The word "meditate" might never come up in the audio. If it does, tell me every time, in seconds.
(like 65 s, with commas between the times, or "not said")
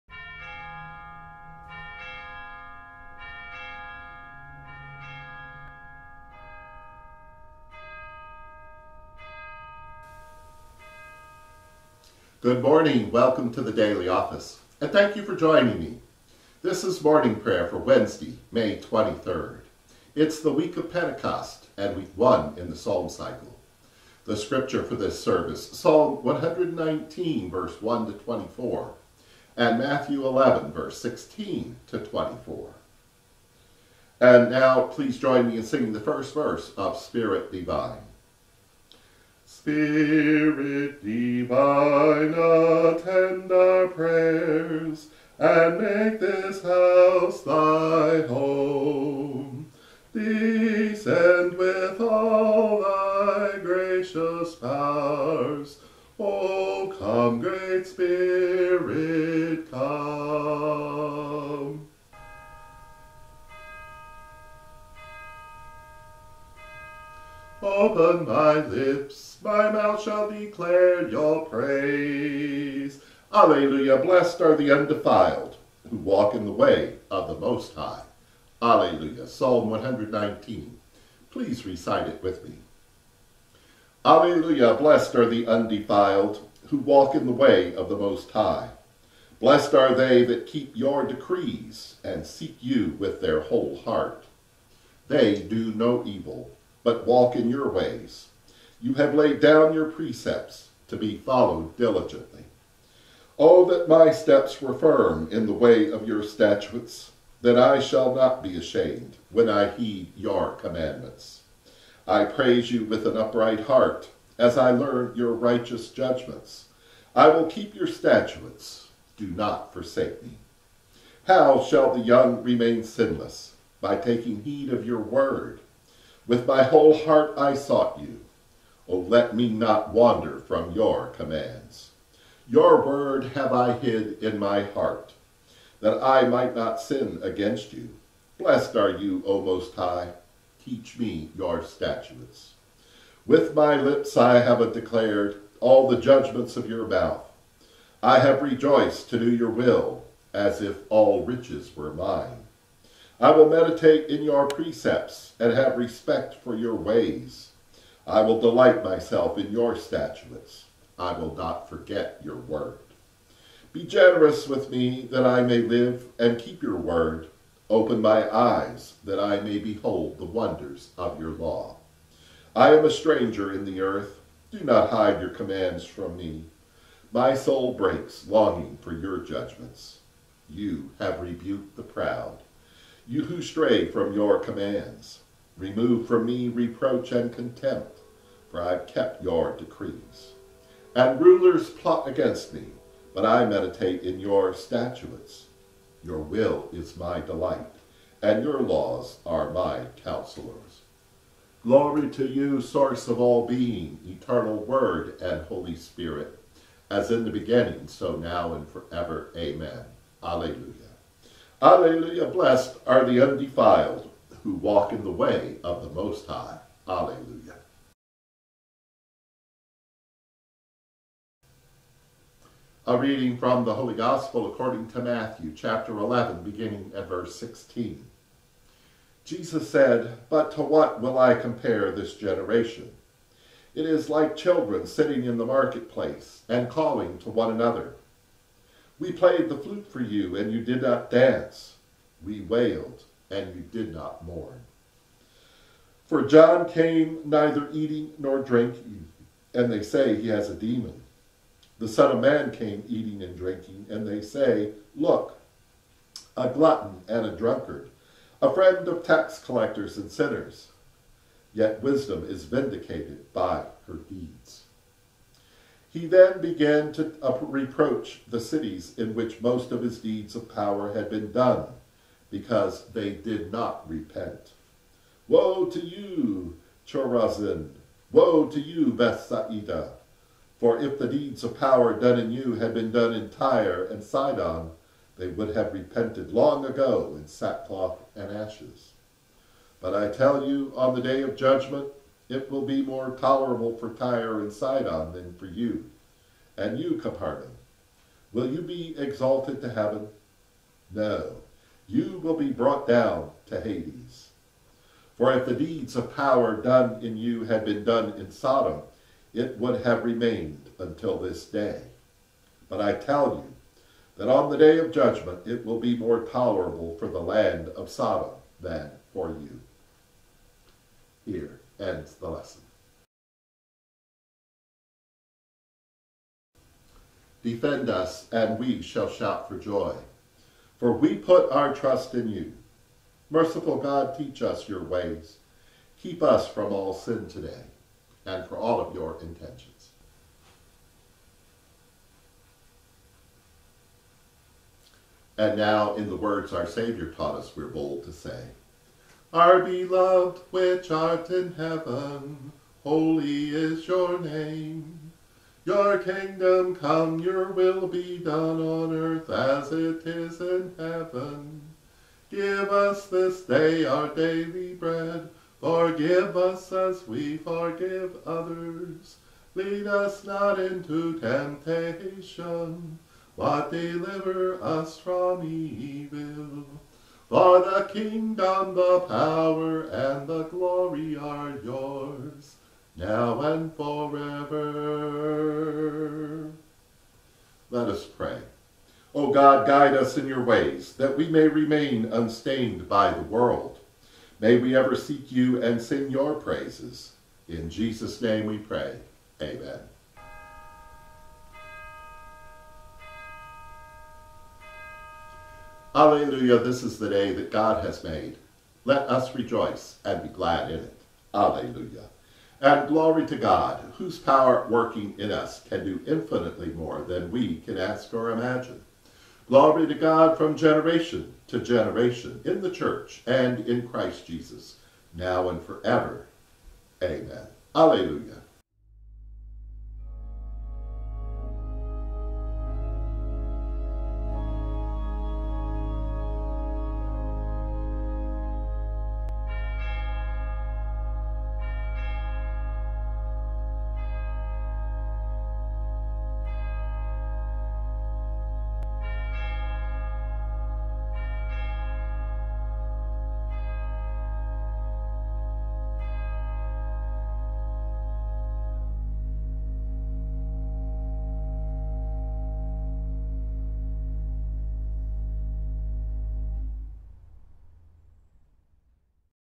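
153 s, 193 s.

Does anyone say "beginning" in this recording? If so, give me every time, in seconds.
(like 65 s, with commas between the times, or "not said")
207 s, 226 s.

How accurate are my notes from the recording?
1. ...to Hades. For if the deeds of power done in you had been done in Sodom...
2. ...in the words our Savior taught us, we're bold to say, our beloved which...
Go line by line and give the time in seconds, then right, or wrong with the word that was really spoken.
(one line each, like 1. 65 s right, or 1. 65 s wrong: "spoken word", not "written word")
1. 303 s right
2. 345 s right.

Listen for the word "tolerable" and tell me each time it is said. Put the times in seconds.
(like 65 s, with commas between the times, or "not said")
293 s, 316 s.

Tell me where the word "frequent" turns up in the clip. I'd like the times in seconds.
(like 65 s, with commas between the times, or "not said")
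not said.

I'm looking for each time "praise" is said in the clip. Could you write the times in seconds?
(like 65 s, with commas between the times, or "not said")
71 s, 112 s, 396 s.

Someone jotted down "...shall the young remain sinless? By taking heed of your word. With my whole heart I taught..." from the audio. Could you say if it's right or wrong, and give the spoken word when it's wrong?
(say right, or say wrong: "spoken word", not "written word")
wrong: "sought", not "taught".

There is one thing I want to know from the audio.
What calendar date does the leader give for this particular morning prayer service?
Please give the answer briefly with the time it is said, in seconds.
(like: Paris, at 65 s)
Wednesday, May 23rd, at 17 s.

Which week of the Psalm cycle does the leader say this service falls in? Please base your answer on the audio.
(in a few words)
week one.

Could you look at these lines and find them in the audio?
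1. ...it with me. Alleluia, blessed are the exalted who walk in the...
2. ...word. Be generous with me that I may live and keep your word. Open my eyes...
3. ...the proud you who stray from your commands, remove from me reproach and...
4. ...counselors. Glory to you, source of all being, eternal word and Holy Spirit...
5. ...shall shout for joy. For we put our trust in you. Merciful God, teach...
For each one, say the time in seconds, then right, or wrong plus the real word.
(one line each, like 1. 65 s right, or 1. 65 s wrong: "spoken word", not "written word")
1. 82 s wrong: "undefiled", not "exalted"
2. 162 s right
3. 181 s right
4. 200 s right
5. 328 s right.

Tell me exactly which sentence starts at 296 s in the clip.
And you, Capernaum, will you be exalted to heaven?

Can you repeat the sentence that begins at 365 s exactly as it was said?
Forgive us as we forgive others.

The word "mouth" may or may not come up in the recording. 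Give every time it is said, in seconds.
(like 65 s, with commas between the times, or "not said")
69 s, 146 s.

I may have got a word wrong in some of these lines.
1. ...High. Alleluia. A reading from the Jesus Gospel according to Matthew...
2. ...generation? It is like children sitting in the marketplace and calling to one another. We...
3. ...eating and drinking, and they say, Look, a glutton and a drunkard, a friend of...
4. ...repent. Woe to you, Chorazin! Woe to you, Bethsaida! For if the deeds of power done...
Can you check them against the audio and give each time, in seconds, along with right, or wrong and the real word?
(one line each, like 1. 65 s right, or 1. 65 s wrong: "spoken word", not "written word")
1. 216 s wrong: "Holy", not "Jesus"
2. 232 s right
3. 252 s right
4. 273 s right.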